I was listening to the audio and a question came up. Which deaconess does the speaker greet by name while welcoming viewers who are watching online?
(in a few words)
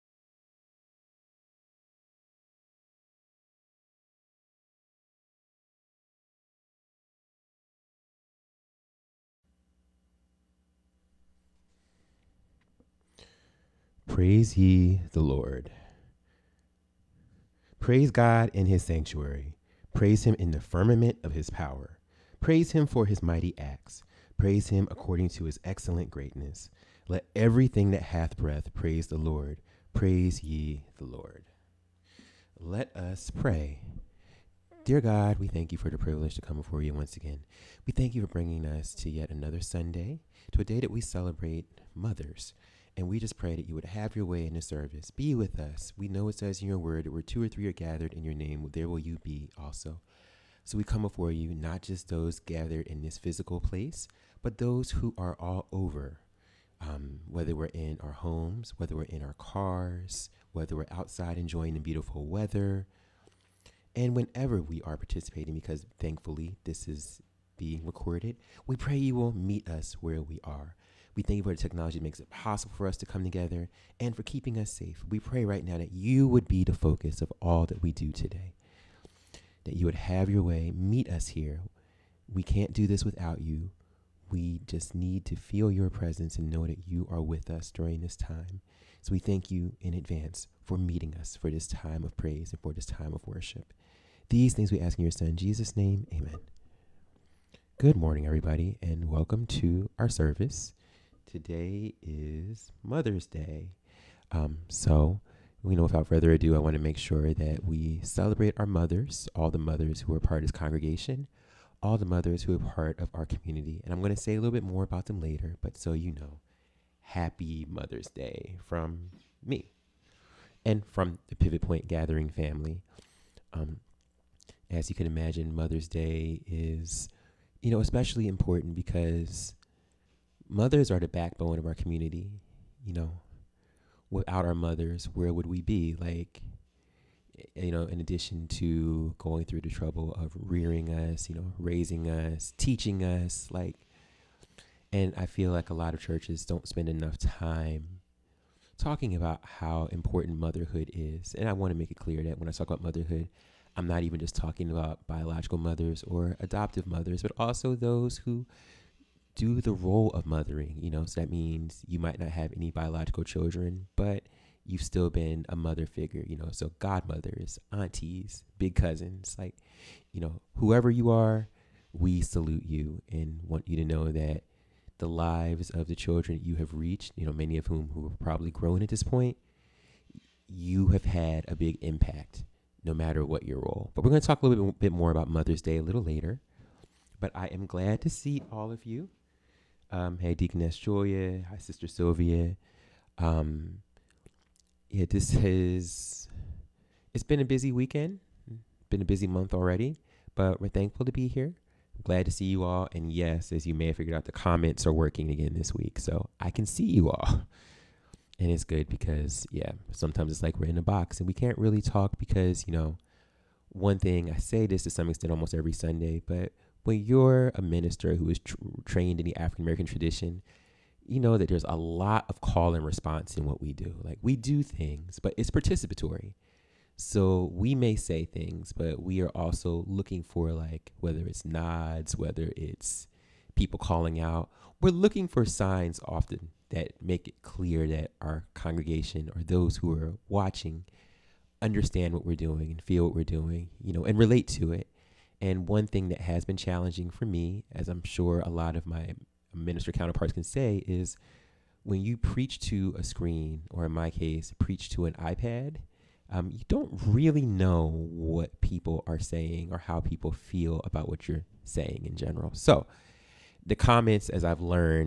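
Julia.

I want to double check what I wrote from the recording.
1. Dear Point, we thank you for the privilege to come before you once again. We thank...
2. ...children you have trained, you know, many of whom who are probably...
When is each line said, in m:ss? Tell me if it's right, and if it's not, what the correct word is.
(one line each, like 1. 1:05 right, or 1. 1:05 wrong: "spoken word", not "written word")
1. 0:34 wrong: "God", not "Point"
2. 2:55 wrong: "reached", not "trained".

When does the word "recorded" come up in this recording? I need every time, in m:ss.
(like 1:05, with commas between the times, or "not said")
1:07.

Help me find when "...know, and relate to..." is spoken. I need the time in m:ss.
4:03.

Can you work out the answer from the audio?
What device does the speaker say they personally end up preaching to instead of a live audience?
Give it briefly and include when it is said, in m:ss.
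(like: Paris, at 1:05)
iPad, at 4:15.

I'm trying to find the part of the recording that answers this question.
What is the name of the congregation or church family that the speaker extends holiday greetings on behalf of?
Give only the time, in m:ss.
2:01.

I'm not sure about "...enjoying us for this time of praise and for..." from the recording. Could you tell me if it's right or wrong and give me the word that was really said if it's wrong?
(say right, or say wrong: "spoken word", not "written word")
wrong: "meeting", not "enjoying".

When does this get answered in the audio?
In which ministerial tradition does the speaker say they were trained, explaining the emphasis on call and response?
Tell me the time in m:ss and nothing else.
3:39.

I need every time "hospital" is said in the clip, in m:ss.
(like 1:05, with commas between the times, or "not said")
not said.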